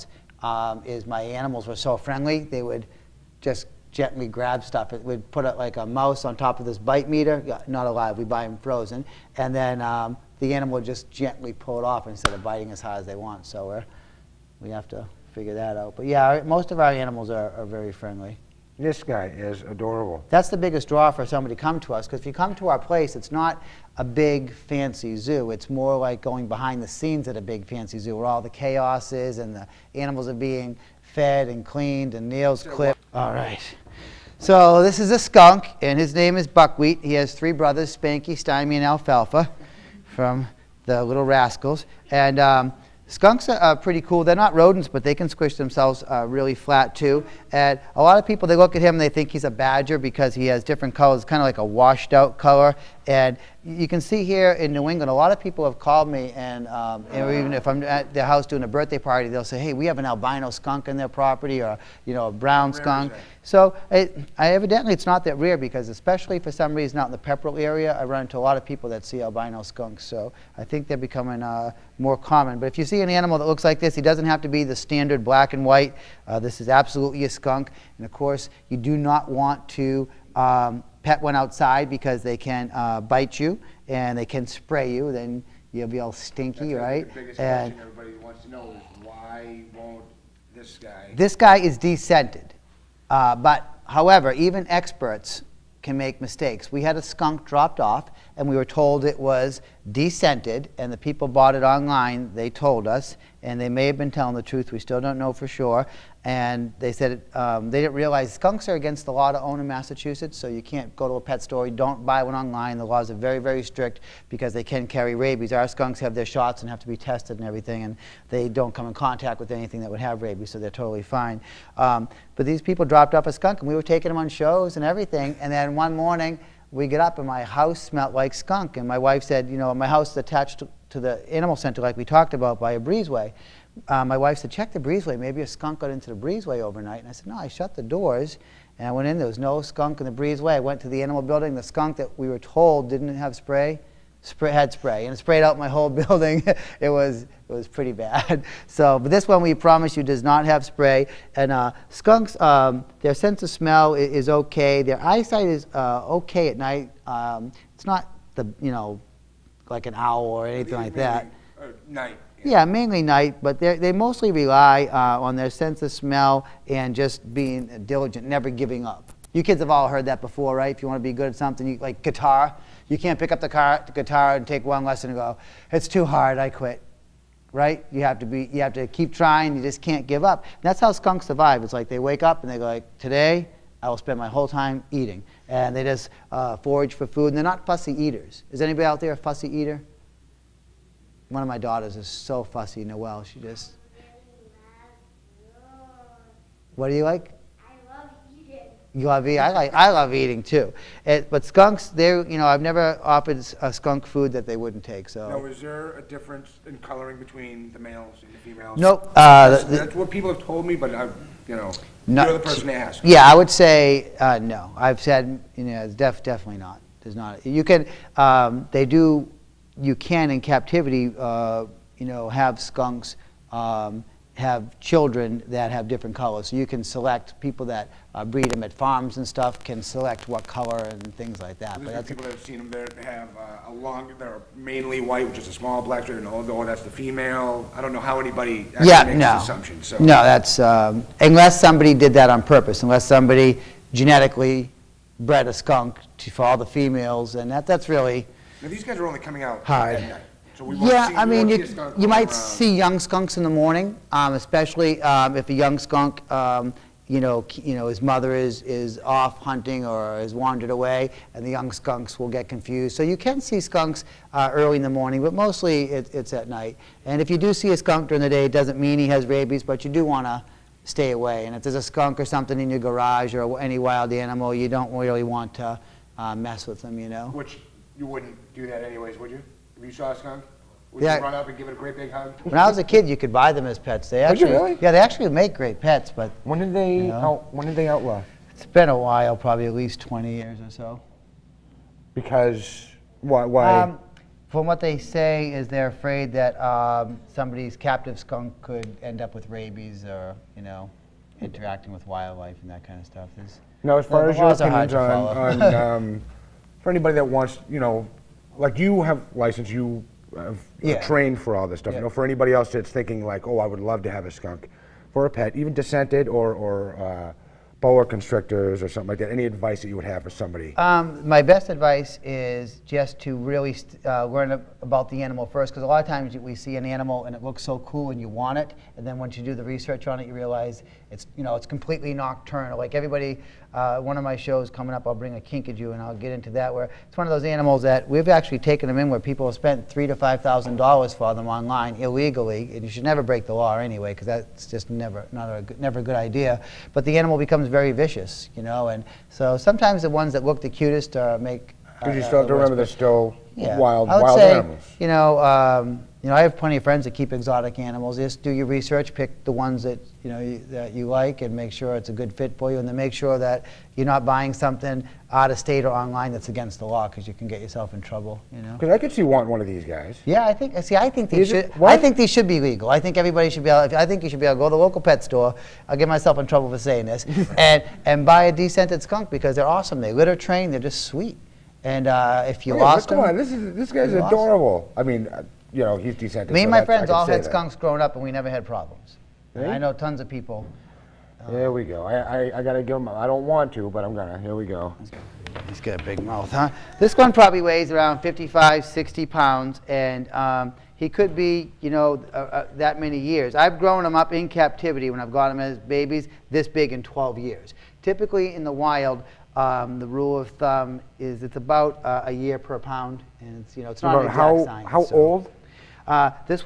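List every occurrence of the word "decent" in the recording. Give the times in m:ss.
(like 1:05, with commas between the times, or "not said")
6:26.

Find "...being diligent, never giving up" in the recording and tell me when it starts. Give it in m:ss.
2:47.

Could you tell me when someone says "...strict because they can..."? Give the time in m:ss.
1:53.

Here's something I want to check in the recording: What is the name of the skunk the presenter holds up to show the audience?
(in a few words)
Buckwheat.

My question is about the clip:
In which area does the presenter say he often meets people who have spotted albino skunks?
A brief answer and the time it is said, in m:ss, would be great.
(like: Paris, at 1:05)
Pepperell, at 1:07.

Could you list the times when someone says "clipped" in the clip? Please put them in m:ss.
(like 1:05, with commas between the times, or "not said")
0:32.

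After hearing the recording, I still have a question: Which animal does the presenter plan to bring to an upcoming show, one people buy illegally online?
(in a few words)
Kinkajou.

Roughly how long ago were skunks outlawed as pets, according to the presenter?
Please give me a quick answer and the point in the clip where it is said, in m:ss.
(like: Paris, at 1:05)
20 years, at 4:49.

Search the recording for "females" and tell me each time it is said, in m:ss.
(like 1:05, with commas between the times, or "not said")
3:28, 3:56, 4:06.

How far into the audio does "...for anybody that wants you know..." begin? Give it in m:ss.
5:06.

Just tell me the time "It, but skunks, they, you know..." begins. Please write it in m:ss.
3:21.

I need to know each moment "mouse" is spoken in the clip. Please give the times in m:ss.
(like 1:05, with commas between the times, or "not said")
0:05.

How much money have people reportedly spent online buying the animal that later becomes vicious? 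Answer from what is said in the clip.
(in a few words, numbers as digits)
3,000 to 5,000 dollars.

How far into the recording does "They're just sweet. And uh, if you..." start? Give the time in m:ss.
6:20.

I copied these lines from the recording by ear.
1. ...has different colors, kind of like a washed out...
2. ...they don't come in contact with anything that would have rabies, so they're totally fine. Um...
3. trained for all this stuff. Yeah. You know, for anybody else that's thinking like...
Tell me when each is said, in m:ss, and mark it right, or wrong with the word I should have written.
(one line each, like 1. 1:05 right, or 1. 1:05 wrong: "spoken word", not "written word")
1. 0:50 right
2. 1:58 right
3. 5:11 right.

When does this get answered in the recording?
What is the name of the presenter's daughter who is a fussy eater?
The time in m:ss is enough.
3:12.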